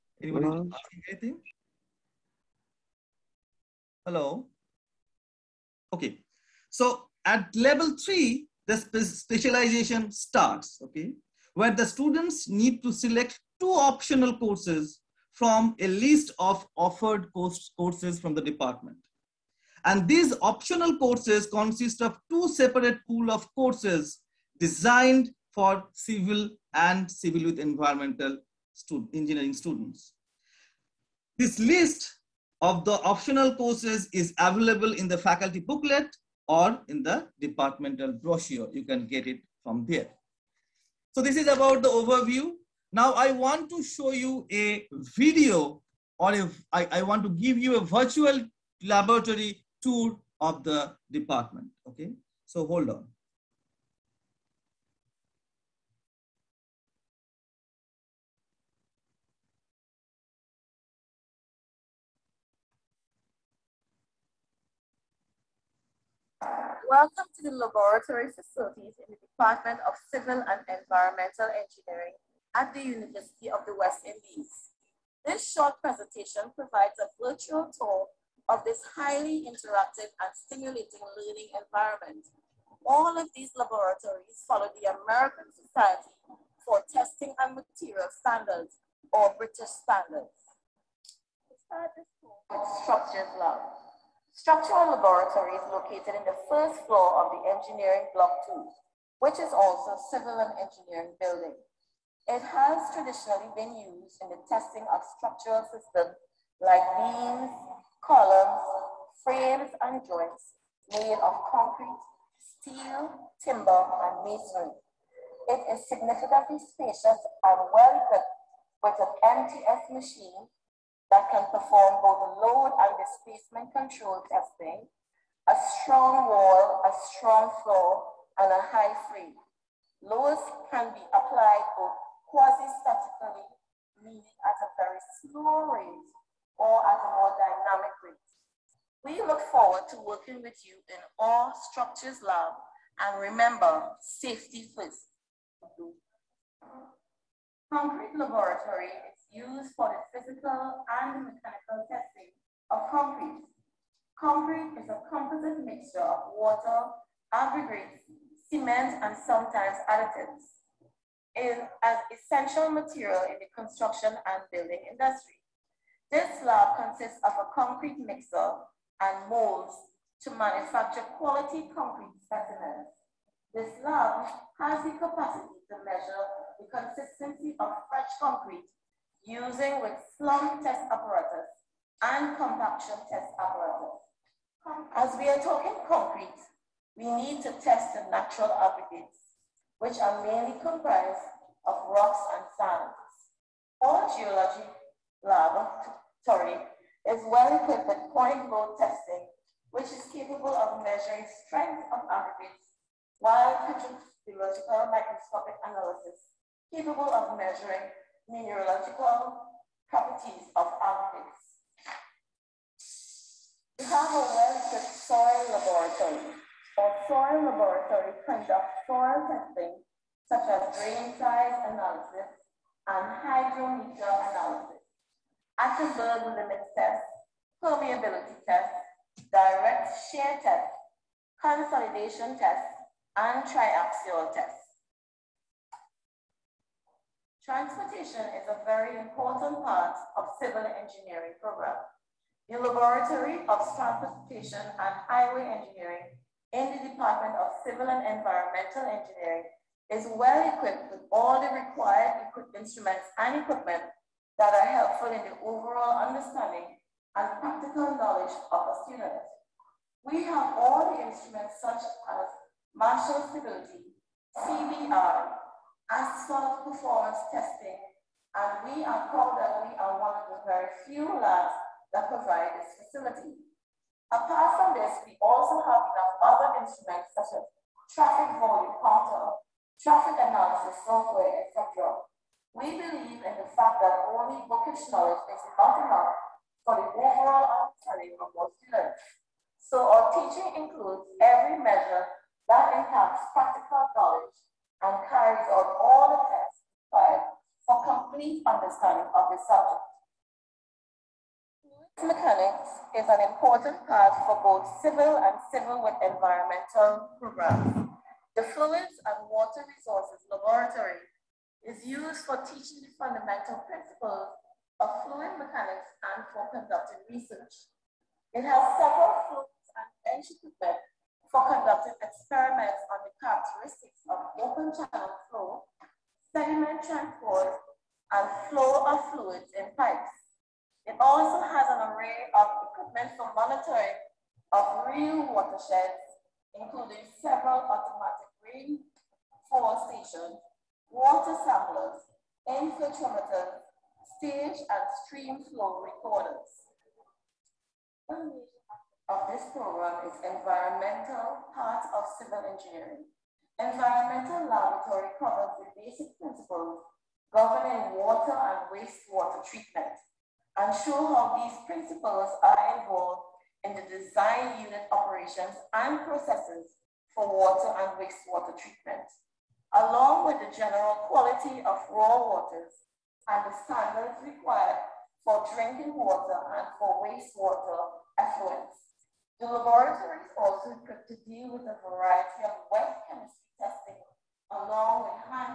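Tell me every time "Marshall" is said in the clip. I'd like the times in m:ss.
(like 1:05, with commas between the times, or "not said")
4:22.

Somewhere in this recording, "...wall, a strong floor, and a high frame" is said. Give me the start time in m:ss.
2:06.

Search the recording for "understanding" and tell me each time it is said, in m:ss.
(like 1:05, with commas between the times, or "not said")
4:15, 4:47, 4:58.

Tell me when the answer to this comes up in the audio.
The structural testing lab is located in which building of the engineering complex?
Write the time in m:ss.
1:37.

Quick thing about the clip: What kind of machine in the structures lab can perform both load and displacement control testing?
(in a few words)
MTS machine.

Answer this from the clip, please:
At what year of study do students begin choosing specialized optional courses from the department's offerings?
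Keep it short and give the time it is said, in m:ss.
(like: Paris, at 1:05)
Level 3, at 0:07.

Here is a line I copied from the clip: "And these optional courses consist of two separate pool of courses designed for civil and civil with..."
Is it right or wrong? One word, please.
right.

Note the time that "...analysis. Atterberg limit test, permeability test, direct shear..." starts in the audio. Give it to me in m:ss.
3:44.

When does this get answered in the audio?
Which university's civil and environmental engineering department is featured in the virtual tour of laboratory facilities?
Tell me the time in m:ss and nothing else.
1:12.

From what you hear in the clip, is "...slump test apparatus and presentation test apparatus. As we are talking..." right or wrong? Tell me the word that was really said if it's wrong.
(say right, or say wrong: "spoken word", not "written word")
wrong: "compaction", not "presentation".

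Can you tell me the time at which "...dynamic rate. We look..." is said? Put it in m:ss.
2:17.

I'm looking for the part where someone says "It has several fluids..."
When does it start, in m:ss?
5:18.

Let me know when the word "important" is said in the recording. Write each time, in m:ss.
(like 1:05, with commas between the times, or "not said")
3:59, 5:03.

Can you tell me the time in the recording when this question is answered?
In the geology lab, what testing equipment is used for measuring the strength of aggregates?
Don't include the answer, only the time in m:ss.
3:18.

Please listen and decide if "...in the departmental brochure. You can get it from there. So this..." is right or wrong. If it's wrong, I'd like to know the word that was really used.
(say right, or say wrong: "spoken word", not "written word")
right.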